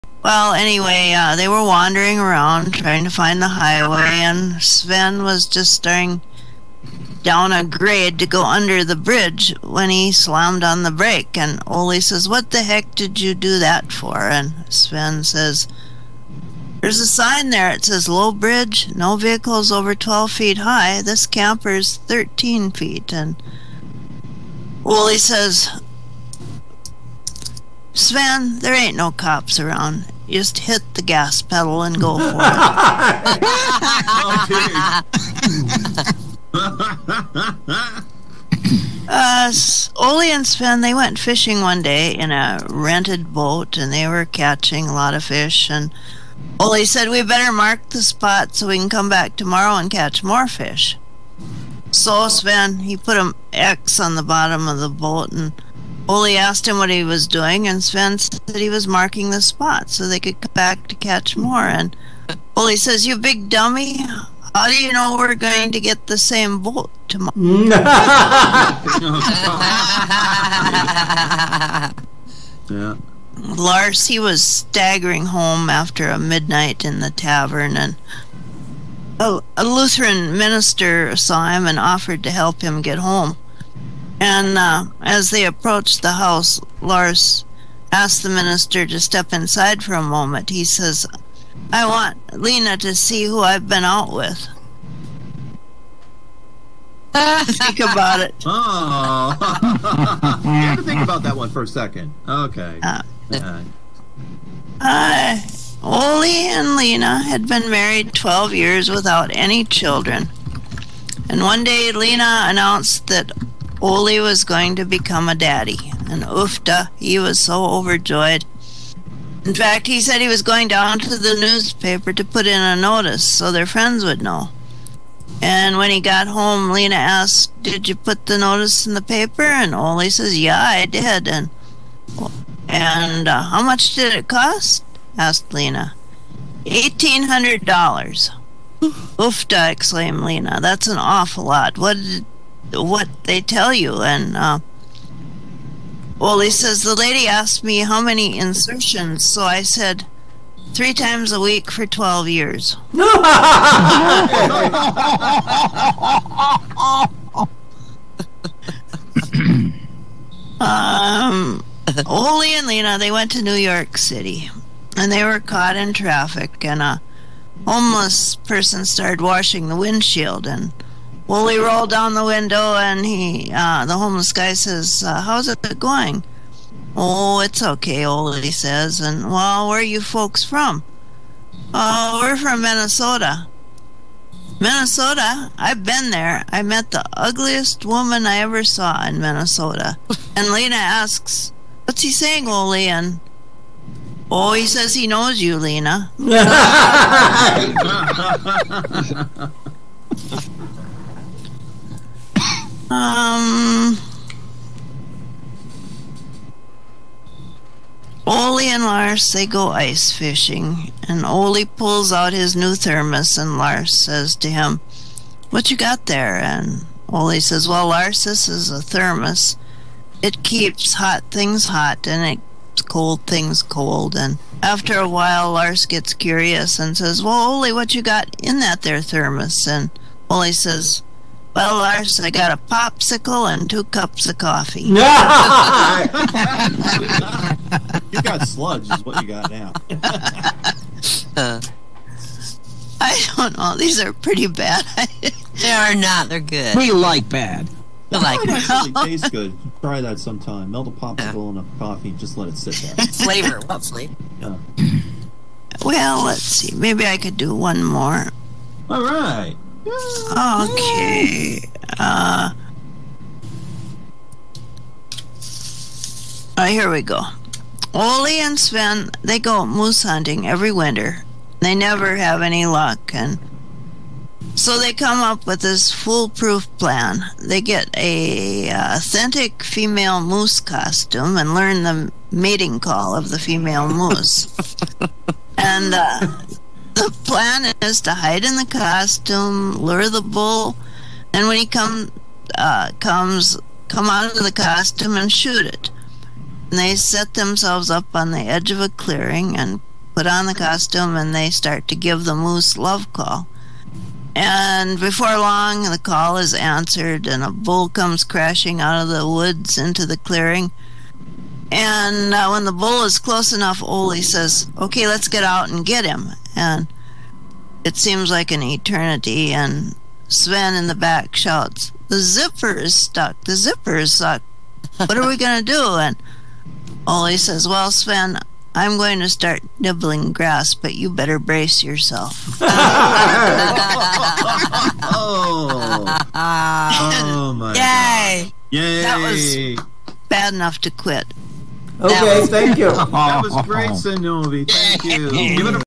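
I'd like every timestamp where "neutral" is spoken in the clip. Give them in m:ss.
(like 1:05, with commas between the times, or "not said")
not said.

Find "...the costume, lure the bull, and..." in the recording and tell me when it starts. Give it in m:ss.
4:48.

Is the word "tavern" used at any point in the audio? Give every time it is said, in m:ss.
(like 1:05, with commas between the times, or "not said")
1:17.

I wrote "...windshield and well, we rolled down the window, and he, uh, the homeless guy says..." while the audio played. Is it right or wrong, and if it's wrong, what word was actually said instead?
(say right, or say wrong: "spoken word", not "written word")
right.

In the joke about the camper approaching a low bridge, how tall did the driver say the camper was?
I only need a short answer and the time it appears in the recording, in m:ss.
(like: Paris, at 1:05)
13 feet, at 0:21.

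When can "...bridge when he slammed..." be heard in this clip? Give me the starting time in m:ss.
0:08.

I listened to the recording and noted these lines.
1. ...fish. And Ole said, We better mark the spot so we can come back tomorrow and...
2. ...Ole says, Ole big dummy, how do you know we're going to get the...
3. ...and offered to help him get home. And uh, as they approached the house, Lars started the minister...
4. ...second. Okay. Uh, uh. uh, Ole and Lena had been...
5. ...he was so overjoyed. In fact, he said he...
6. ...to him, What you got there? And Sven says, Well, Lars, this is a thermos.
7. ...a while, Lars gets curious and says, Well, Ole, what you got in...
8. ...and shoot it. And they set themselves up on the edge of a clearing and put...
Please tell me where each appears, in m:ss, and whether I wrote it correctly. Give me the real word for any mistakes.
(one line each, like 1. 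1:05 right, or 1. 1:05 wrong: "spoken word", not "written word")
1. 0:45 right
2. 1:02 wrong: "You", not "Ole"
3. 1:21 wrong: "asked", not "started"
4. 1:41 right
5. 1:56 right
6. 3:34 wrong: "Ole", not "Sven"
7. 3:44 right
8. 4:55 right.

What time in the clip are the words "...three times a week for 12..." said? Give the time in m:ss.
2:30.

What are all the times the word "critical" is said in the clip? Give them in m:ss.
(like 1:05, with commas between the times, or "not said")
not said.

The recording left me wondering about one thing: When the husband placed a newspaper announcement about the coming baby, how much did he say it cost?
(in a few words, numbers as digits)
$1,800.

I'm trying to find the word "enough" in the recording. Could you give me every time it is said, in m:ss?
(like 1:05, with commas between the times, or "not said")
5:13, 5:40.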